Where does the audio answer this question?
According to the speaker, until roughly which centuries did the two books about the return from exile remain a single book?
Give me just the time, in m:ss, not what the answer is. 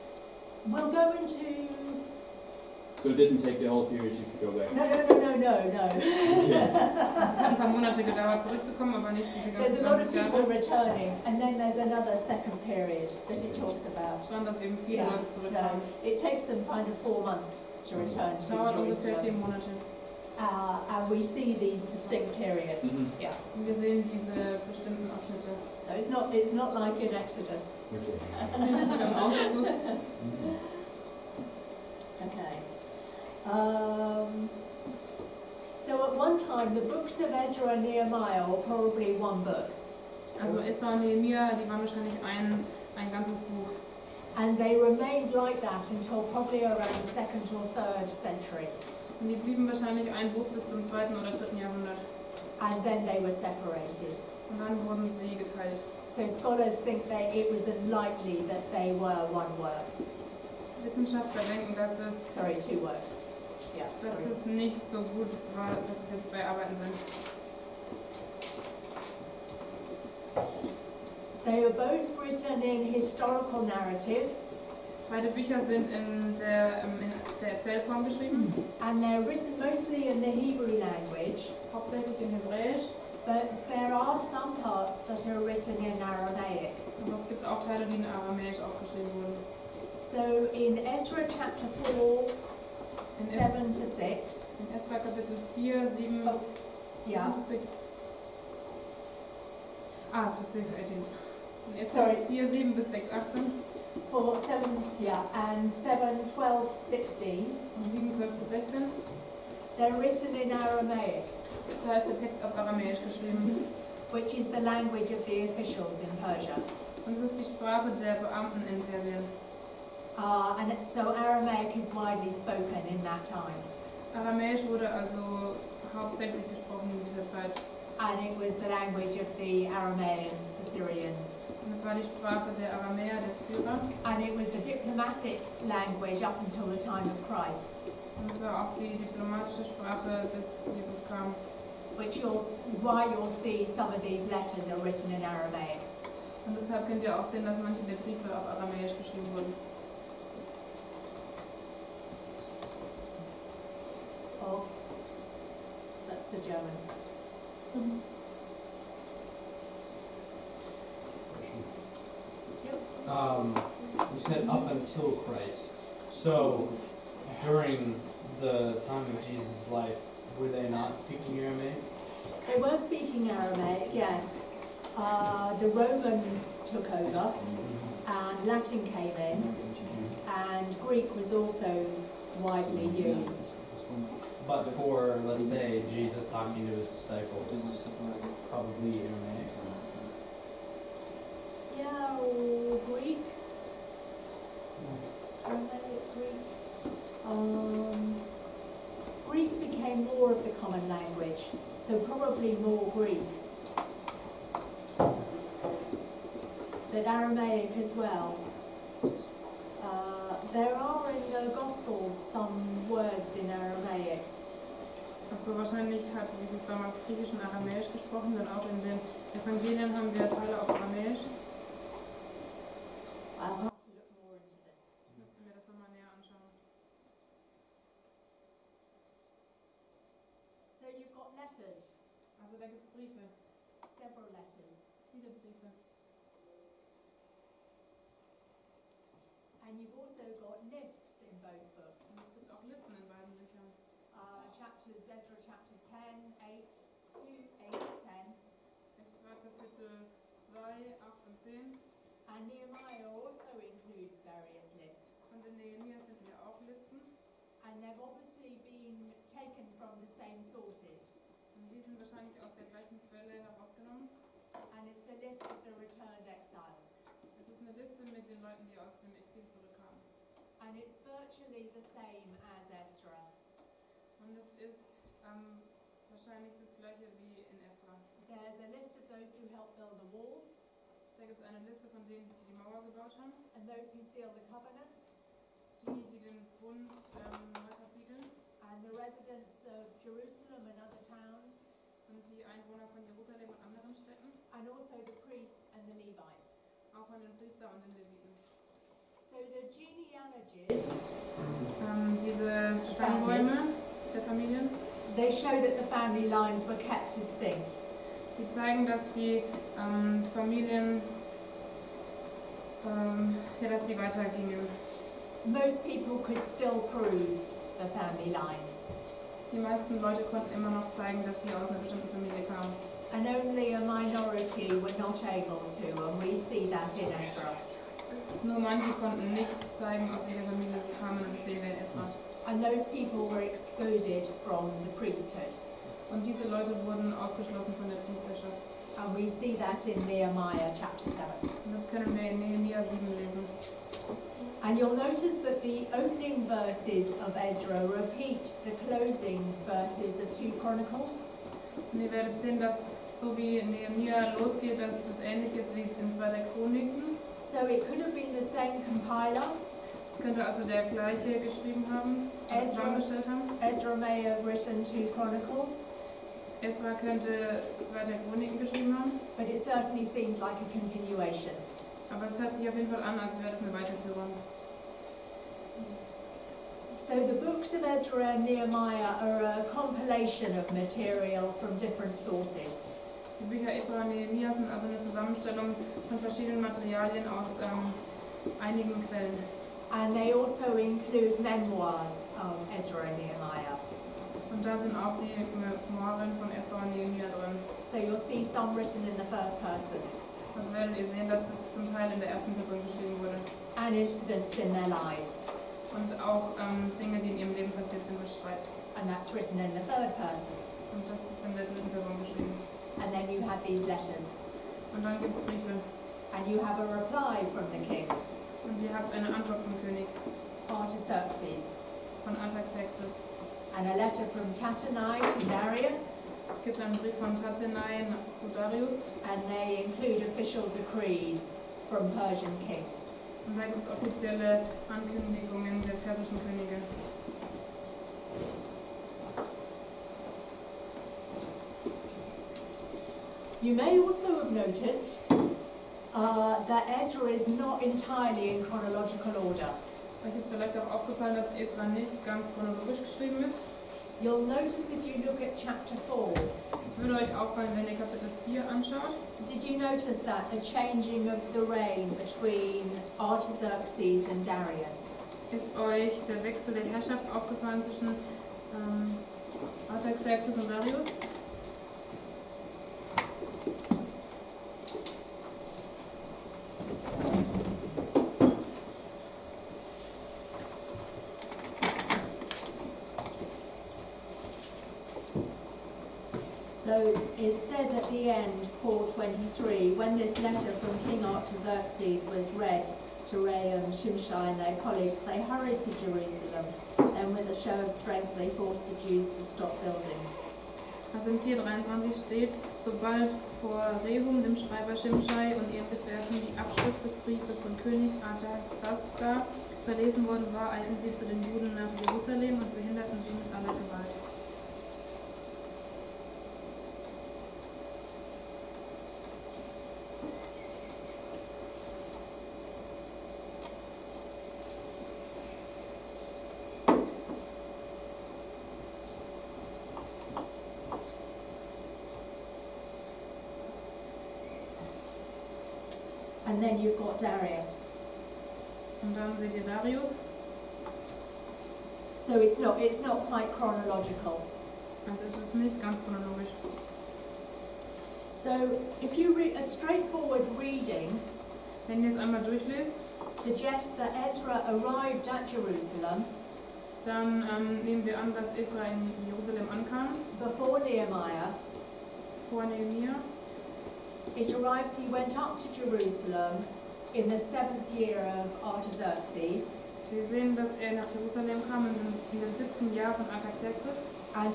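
0:47.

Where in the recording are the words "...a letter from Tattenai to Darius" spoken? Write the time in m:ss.
7:03.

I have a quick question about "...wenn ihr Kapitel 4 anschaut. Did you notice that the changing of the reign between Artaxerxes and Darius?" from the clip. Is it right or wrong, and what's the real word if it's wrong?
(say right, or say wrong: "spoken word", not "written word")
right.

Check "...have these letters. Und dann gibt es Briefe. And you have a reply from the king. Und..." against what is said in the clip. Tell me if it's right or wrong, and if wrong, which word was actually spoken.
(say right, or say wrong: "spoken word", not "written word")
right.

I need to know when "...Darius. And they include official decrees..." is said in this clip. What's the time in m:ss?
7:08.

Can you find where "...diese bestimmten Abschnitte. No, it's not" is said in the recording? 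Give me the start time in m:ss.
0:24.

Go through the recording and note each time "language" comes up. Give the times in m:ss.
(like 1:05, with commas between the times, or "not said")
1:20, 1:54, 2:08, 2:15, 3:20.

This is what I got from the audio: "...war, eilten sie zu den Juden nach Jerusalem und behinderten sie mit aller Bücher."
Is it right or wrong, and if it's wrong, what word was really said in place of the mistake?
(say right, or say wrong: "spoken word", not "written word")
wrong: "Gewalt", not "Bücher".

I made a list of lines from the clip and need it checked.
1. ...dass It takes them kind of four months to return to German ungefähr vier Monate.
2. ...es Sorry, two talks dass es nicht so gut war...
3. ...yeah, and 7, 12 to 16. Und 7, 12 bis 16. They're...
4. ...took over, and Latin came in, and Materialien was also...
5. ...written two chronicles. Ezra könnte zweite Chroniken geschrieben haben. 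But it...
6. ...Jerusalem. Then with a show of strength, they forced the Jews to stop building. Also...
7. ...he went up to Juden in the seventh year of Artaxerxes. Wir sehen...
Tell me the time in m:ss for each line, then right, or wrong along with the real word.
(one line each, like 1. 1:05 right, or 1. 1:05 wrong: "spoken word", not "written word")
1. 0:14 wrong: "Dauert", not "German"
2. 1:01 wrong: "works", not "talks"
3. 1:44 right
4. 2:56 wrong: "Greek", not "Materialien"
5. 6:04 right
6. 8:16 right
7. 9:24 wrong: "Jerusalem", not "Juden".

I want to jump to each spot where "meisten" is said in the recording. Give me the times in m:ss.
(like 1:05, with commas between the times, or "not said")
5:19.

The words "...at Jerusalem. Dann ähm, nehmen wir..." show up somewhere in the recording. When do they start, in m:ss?
9:15.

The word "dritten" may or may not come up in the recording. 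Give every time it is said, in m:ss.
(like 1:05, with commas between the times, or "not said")
0:51, 6:51.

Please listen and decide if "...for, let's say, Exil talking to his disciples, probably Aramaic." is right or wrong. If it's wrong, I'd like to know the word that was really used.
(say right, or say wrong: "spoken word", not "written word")
wrong: "Jesus", not "Exil".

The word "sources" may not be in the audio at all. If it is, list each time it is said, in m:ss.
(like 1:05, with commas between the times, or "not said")
4:20, 6:22.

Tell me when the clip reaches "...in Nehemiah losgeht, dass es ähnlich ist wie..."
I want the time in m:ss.
5:53.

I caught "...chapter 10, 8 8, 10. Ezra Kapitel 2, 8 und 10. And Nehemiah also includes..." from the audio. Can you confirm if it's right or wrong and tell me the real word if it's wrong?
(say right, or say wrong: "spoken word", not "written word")
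right.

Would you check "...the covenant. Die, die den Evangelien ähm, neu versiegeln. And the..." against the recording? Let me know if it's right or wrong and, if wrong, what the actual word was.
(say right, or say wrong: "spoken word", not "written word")
wrong: "Bund", not "Evangelien".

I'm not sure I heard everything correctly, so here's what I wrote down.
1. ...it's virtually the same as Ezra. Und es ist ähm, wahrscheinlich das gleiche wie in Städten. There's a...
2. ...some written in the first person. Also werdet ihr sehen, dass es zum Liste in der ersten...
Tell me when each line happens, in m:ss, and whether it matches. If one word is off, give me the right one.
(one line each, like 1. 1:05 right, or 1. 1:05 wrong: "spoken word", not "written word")
1. 4:30 wrong: "Esra", not "Städten"
2. 6:38 wrong: "Teil", not "Liste".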